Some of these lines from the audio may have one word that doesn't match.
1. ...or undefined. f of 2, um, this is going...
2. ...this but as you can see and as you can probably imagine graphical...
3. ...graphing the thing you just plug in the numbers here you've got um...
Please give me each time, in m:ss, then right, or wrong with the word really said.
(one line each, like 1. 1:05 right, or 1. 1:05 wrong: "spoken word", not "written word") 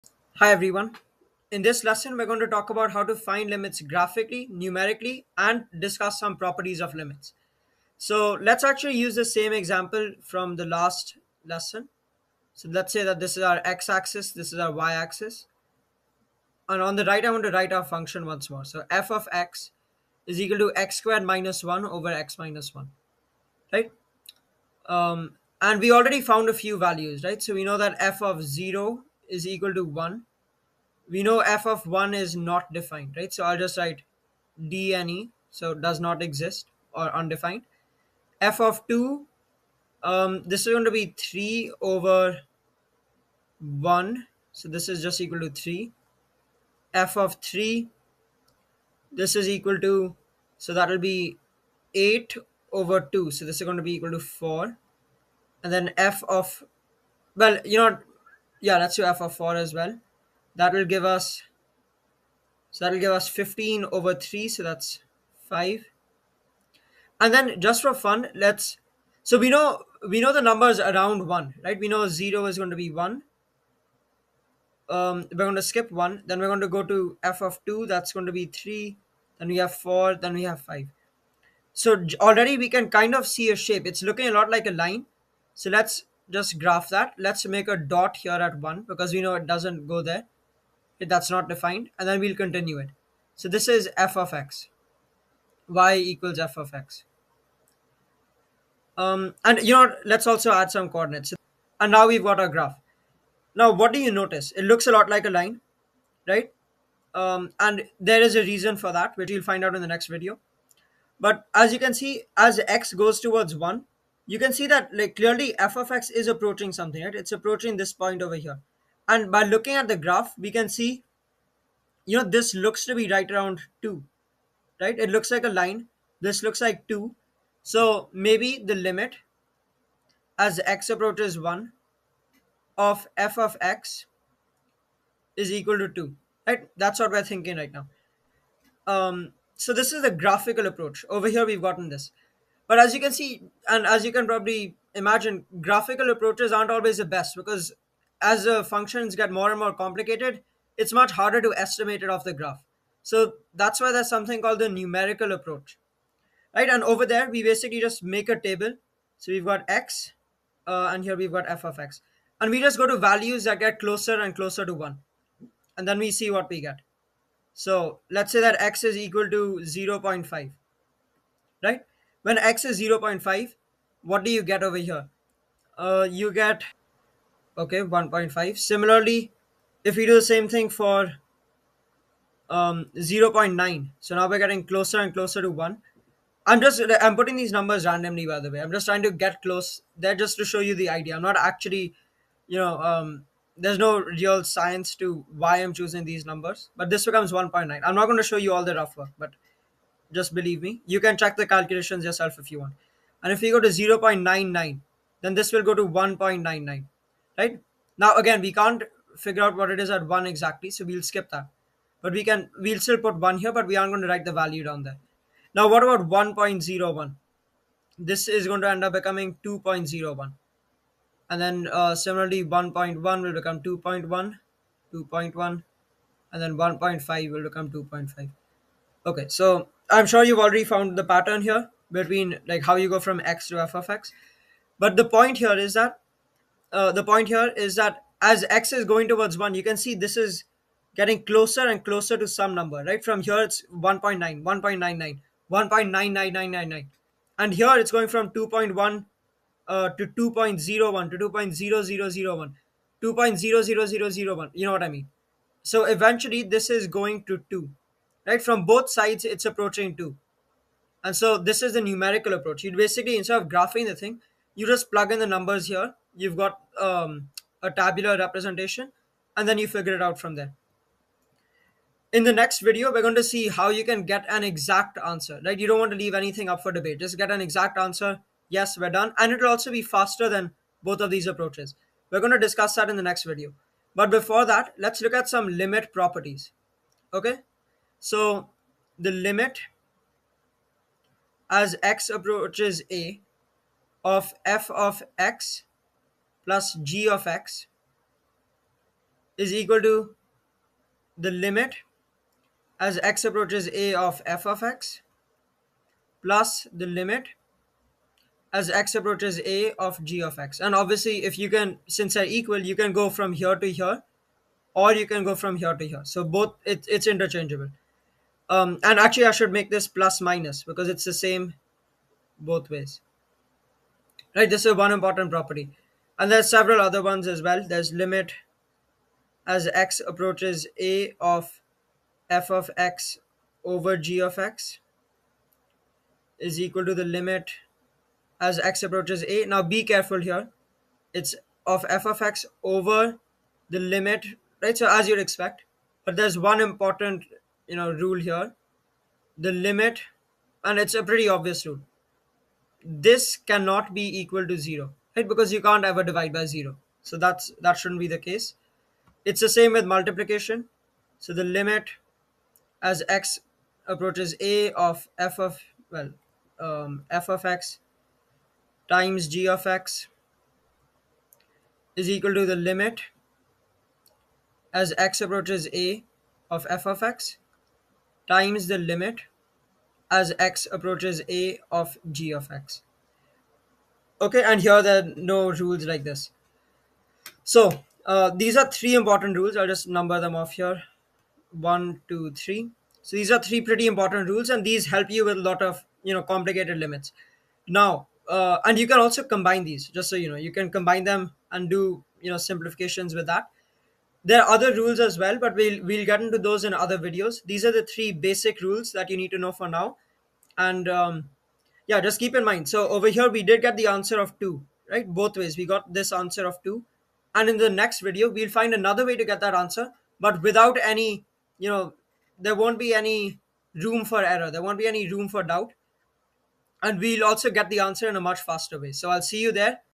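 1. 0:36 right
2. 2:21 right
3. 4:23 right.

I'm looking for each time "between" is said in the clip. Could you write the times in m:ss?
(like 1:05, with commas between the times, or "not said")
3:51.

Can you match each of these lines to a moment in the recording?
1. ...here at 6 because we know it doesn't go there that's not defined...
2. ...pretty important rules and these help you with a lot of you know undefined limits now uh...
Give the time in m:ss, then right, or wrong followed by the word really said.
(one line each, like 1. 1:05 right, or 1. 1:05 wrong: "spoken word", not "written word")
1. 1:28 wrong: "1", not "6"
2. 6:33 wrong: "complicated", not "undefined".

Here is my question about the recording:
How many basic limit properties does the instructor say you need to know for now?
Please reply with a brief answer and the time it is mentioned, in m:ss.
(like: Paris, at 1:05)
3, at 6:47.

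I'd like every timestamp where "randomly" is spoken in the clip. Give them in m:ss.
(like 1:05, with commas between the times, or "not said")
3:07.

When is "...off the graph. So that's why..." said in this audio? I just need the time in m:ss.
2:32.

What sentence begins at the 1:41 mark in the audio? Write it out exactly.
And now we've got our graph.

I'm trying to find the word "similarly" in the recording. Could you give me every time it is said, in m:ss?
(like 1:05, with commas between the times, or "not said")
2:58, 3:41.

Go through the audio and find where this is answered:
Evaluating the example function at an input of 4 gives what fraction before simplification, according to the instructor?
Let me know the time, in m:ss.
1:03.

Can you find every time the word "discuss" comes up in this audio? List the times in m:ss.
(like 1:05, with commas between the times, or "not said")
0:05, 4:42.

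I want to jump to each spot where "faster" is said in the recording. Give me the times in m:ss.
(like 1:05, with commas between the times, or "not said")
4:39, 7:08.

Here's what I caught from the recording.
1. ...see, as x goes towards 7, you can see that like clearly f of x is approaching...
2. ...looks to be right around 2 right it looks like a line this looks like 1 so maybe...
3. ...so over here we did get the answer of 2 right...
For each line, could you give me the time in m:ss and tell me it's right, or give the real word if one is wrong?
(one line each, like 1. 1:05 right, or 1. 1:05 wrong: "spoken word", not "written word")
1. 1:51 wrong: "1", not "7"
2. 2:02 wrong: "2", not "1"
3. 6:52 right.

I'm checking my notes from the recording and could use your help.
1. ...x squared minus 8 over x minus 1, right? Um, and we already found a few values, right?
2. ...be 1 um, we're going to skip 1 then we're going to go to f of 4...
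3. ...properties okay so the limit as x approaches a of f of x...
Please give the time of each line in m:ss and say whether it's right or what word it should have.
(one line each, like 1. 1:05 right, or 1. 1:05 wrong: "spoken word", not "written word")
1. 0:20 wrong: "1", not "8"
2. 1:12 wrong: "2", not "4"
3. 4:45 right.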